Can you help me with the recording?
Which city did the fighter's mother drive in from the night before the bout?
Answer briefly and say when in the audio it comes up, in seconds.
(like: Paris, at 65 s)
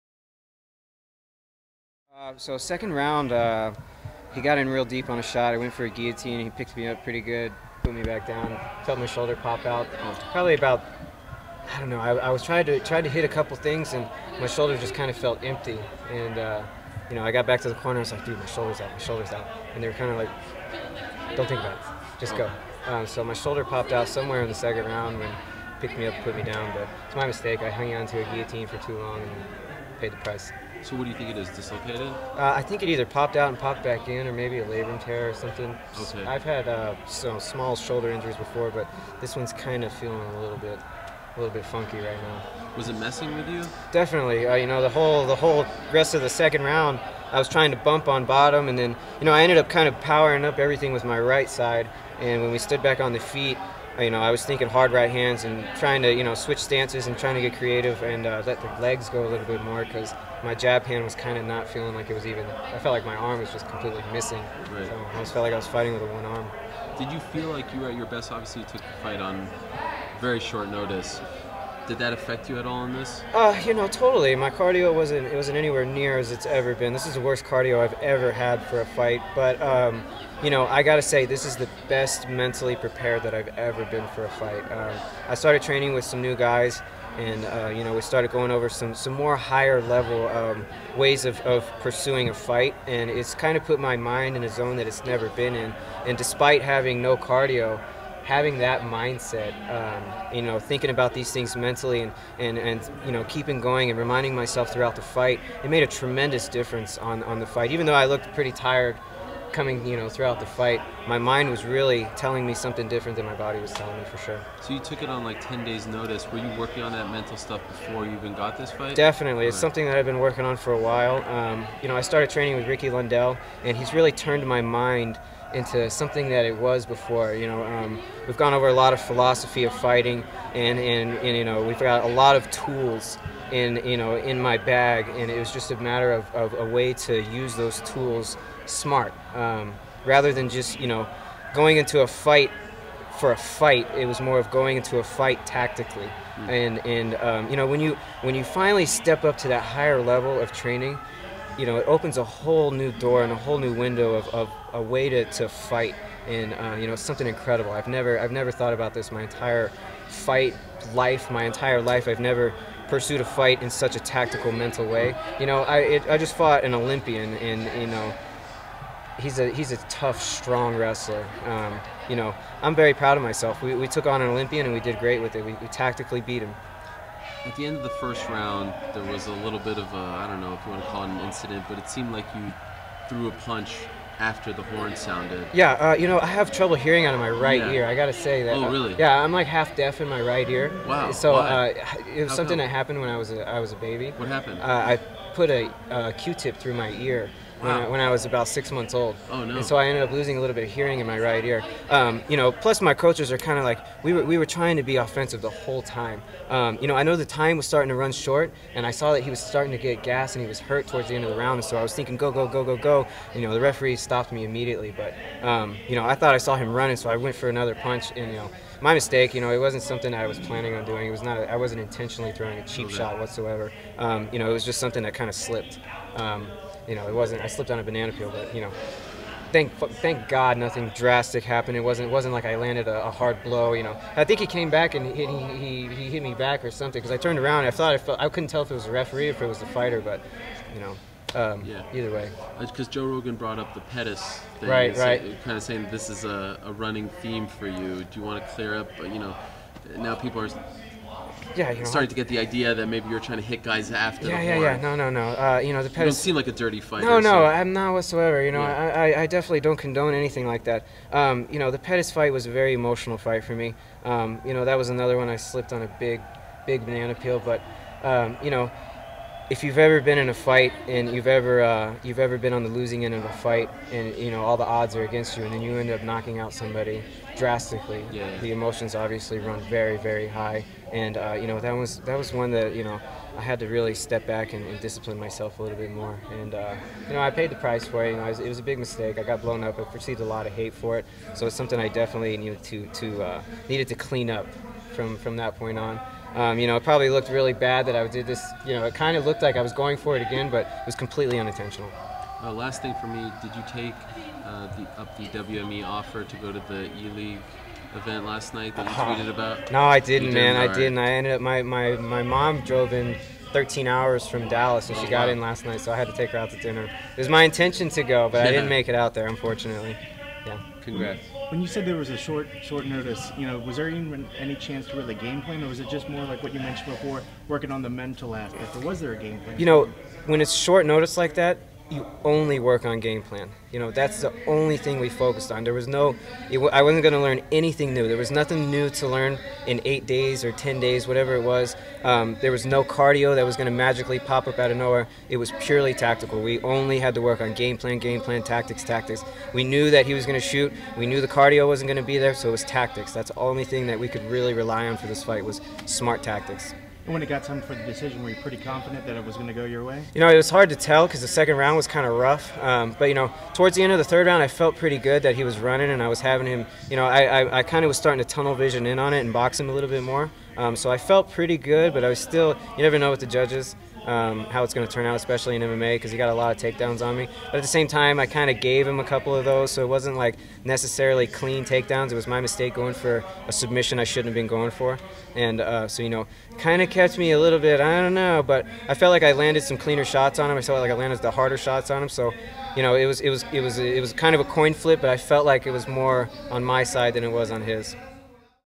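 Dallas, at 314 s.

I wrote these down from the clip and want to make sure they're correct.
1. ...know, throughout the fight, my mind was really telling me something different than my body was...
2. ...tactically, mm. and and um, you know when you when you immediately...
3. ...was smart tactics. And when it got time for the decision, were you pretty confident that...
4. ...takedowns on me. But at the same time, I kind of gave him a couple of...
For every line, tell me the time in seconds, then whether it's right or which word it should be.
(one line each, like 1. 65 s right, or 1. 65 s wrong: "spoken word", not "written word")
1. 109 s right
2. 145 s wrong: "finally", not "immediately"
3. 355 s right
4. 376 s right.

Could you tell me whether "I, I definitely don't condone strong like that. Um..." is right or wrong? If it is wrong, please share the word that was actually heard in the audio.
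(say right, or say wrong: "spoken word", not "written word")
wrong: "anything", not "strong".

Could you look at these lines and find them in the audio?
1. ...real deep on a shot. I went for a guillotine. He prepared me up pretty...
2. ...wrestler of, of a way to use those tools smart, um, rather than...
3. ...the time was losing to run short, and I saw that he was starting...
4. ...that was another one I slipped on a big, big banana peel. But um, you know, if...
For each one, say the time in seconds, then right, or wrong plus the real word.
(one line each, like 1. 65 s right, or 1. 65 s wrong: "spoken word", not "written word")
1. 4 s wrong: "picked", not "prepared"
2. 135 s wrong: "matter", not "wrestler"
3. 207 s wrong: "starting", not "losing"
4. 264 s right.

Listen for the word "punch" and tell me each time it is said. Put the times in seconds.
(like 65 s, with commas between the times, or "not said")
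183 s, 217 s.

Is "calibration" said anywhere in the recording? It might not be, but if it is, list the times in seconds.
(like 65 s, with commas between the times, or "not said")
not said.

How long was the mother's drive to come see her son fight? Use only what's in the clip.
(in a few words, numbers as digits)
13 hours.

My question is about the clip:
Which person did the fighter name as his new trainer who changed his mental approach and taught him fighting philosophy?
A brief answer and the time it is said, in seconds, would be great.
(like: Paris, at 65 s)
Ricky Lundell, at 122 s.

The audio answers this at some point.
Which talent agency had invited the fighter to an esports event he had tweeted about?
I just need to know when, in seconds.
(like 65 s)
305 s.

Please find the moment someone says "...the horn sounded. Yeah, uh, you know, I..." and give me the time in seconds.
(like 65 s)
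184 s.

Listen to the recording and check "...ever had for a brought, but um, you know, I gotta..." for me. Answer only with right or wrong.
wrong.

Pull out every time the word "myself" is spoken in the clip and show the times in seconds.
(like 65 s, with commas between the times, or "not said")
104 s, 173 s, 285 s.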